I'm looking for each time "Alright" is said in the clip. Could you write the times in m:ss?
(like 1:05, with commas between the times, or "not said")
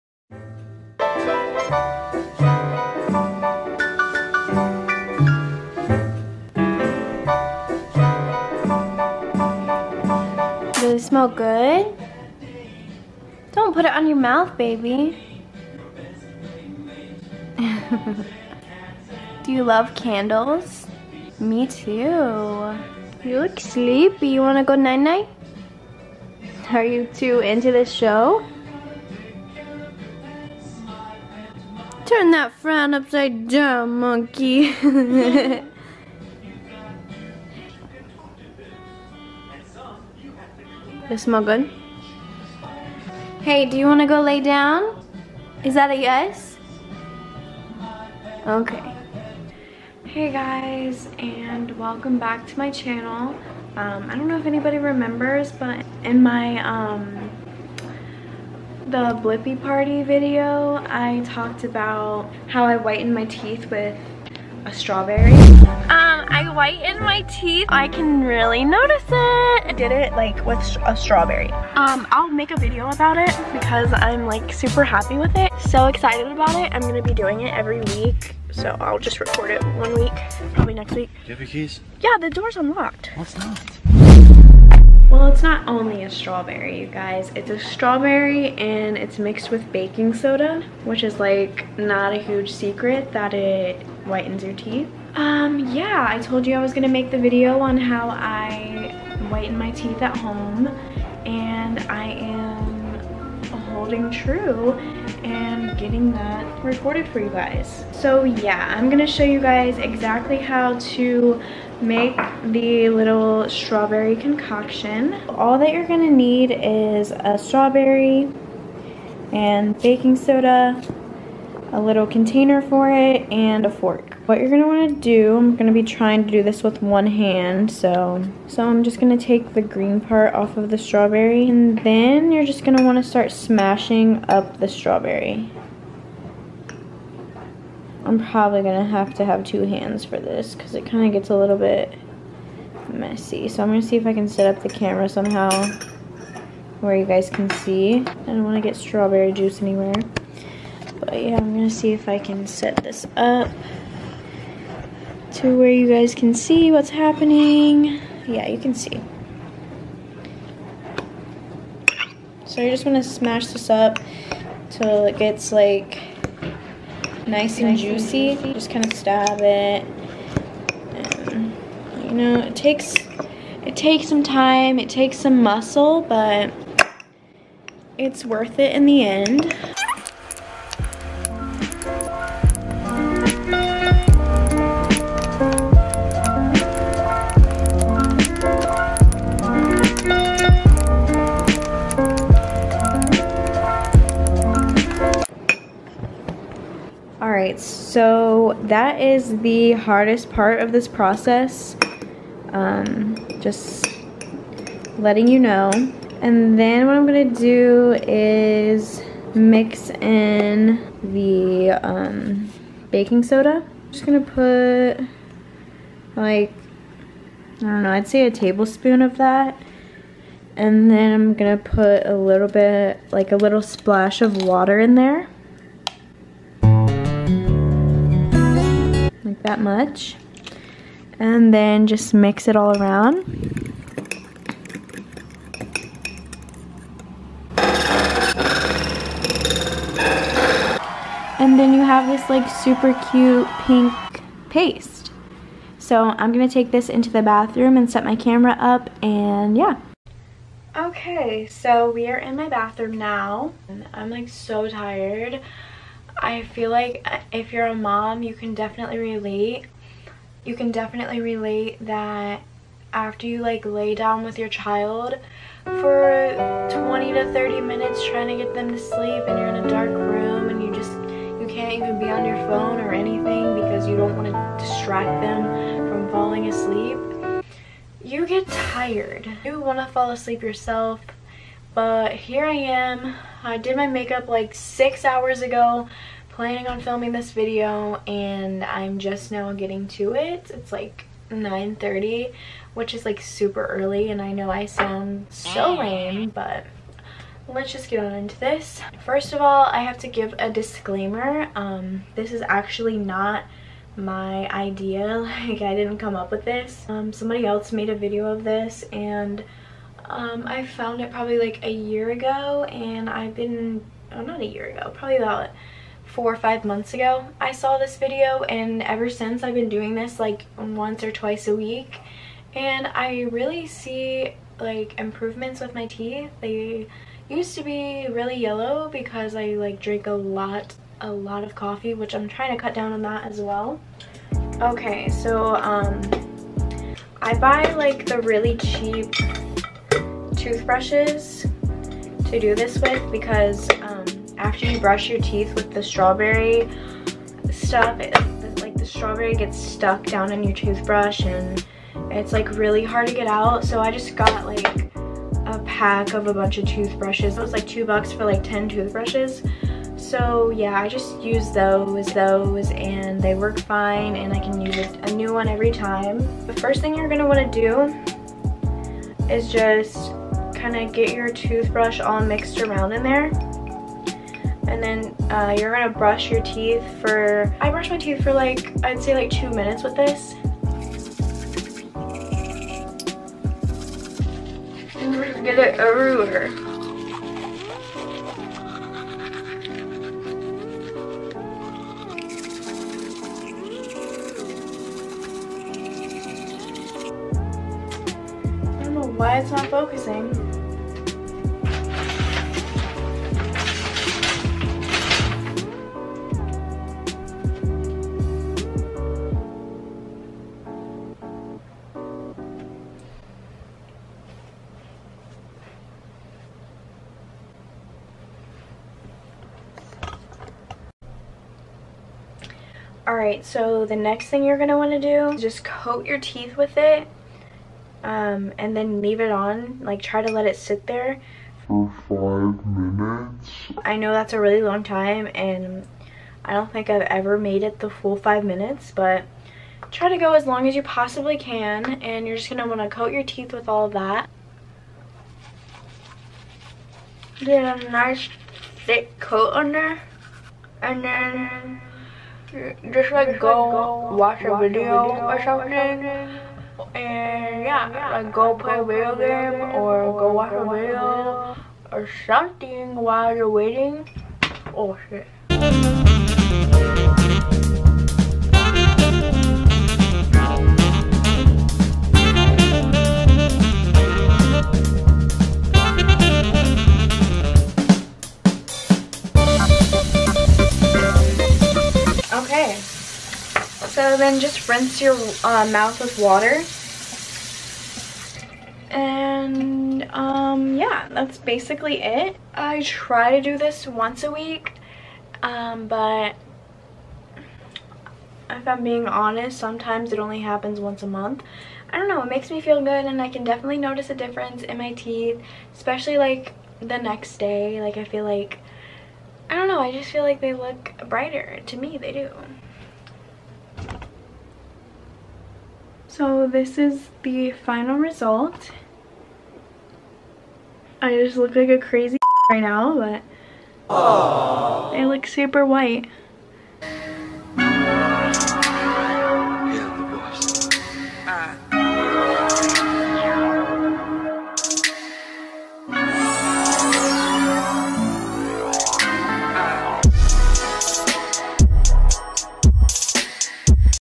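7:03.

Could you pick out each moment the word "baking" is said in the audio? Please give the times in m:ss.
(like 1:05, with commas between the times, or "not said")
1:29, 1:59, 3:32.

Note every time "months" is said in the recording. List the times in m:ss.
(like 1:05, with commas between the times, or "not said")
5:16, 8:21.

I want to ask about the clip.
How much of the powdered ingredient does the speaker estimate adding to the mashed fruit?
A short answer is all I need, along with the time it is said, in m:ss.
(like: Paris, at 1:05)
a tablespoon, at 3:38.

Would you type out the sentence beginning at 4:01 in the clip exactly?
And then you have this like super cute pink paste.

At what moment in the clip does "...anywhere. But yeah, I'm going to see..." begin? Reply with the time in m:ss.
2:29.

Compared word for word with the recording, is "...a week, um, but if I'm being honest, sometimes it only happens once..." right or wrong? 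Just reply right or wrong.
right.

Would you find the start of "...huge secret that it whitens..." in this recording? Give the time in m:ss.
1:32.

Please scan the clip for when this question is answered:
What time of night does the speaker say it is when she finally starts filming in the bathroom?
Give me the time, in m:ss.
4:51.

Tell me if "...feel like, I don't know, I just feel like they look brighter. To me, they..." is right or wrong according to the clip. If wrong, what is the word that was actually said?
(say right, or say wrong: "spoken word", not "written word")
right.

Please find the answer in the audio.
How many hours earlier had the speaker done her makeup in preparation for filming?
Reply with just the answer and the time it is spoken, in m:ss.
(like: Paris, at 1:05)
6, at 4:44.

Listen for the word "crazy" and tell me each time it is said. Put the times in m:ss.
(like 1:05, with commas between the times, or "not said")
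8:41.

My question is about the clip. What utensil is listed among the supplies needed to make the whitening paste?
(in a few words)
a fork.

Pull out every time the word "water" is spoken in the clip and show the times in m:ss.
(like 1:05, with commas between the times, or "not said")
3:44, 8:06.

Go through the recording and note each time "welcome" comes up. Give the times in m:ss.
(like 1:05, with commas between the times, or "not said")
0:51.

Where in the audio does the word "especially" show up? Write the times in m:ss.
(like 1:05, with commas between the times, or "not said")
8:25.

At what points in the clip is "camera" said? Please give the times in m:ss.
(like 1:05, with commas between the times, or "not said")
2:24, 4:08.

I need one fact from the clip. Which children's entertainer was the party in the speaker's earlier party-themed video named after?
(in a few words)
Blippi.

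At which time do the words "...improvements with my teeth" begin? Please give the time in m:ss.
5:24.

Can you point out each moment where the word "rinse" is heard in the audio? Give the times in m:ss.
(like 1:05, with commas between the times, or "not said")
8:04.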